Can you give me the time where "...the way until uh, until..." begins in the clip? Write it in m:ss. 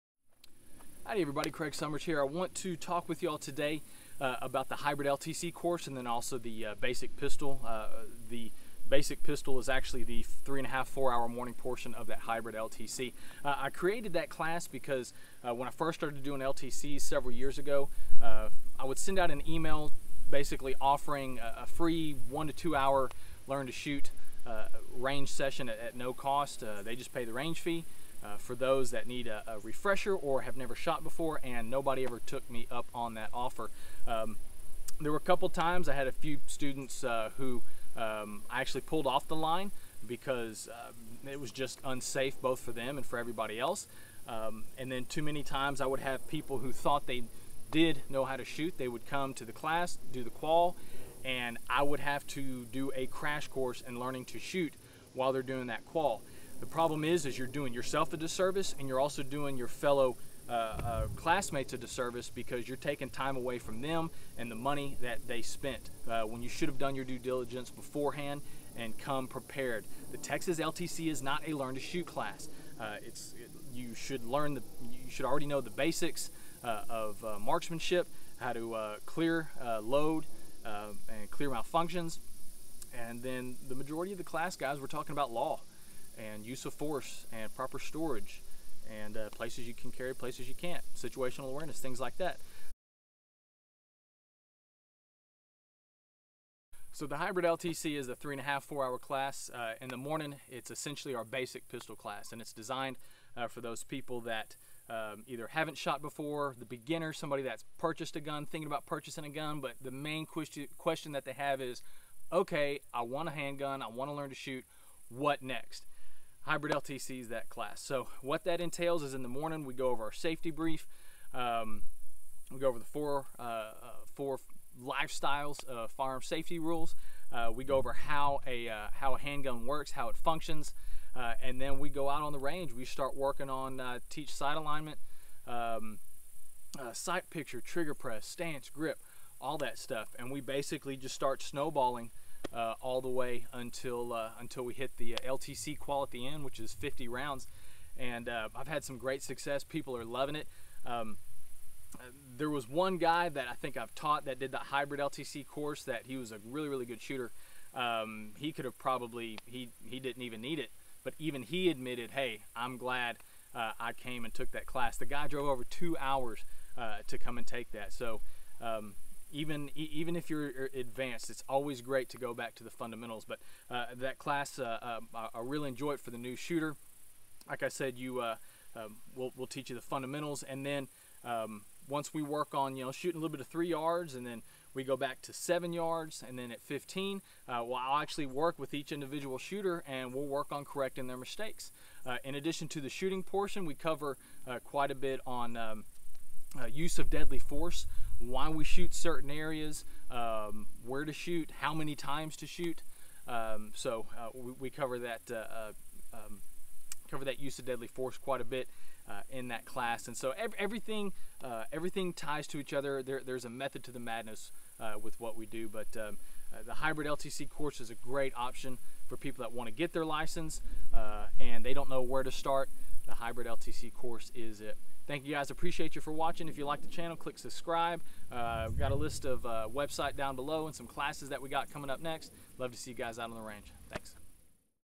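2:23.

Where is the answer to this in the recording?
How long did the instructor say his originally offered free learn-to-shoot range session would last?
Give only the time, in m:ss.
0:22.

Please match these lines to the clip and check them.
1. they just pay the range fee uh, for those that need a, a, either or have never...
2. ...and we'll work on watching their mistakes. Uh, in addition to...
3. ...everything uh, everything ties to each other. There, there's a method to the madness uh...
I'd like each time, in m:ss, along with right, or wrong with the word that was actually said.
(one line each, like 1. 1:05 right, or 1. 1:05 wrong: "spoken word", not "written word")
1. 0:26 wrong: "refresher", not "either"
2. 3:09 wrong: "correcting", not "watching"
3. 3:30 right.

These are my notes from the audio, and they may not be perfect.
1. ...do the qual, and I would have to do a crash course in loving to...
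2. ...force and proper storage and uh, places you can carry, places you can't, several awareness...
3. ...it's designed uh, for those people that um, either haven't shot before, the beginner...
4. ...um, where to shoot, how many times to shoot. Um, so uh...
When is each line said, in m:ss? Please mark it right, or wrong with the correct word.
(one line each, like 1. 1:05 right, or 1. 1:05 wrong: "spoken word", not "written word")
1. 0:50 wrong: "learning", not "loving"
2. 1:26 wrong: "situational", not "several"
3. 1:42 right
4. 3:20 right.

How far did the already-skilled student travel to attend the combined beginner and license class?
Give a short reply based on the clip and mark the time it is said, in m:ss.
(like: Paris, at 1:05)
over 2 hours, at 2:45.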